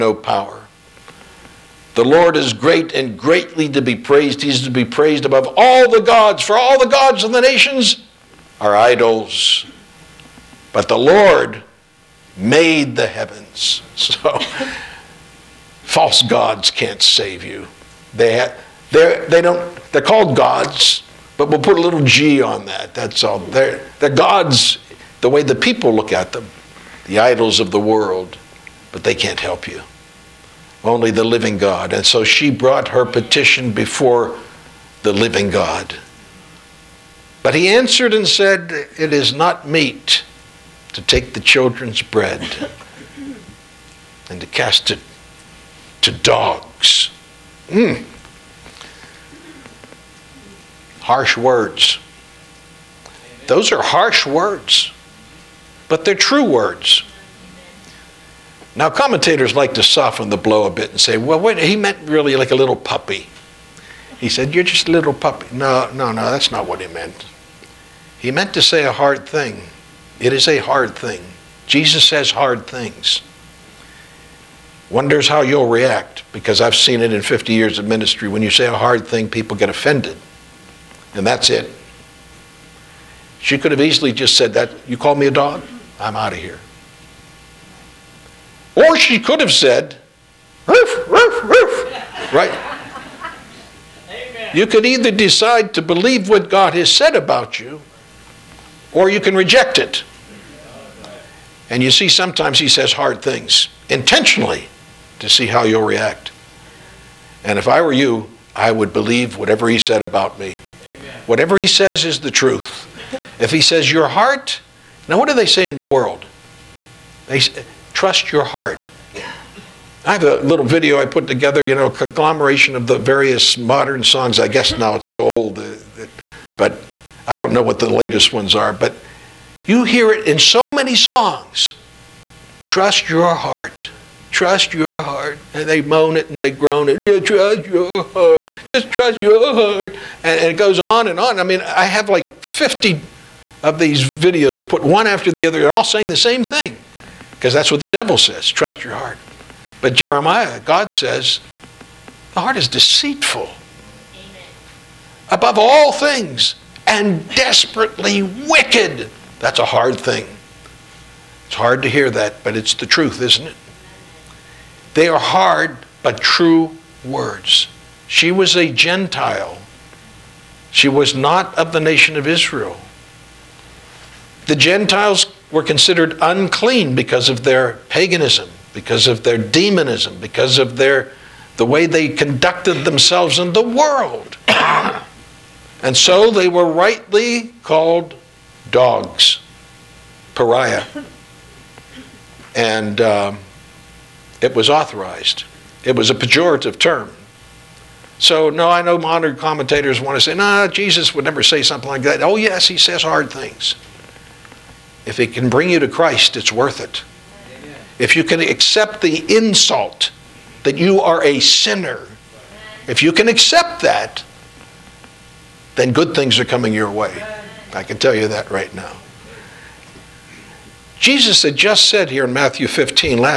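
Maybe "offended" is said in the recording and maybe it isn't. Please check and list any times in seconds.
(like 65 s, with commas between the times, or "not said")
79 s.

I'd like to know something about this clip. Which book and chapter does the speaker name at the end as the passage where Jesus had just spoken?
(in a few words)
Matthew 15.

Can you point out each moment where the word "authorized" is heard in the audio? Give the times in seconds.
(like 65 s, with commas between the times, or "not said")
194 s.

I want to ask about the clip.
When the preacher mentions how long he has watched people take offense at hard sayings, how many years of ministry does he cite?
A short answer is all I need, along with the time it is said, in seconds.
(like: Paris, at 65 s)
50, at 77 s.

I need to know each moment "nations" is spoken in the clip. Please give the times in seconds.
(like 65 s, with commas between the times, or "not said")
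7 s, 171 s.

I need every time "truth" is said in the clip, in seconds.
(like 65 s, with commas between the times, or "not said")
112 s, 162 s.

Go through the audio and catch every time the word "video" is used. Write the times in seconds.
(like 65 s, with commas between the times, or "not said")
120 s, 144 s.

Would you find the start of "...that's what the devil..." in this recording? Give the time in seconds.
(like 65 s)
147 s.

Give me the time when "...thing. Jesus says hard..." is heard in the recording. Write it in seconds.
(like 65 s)
70 s.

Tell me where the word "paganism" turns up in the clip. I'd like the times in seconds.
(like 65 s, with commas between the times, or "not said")
177 s.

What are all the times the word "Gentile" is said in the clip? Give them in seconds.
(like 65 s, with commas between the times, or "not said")
168 s, 174 s.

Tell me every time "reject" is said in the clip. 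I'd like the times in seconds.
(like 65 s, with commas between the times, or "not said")
99 s.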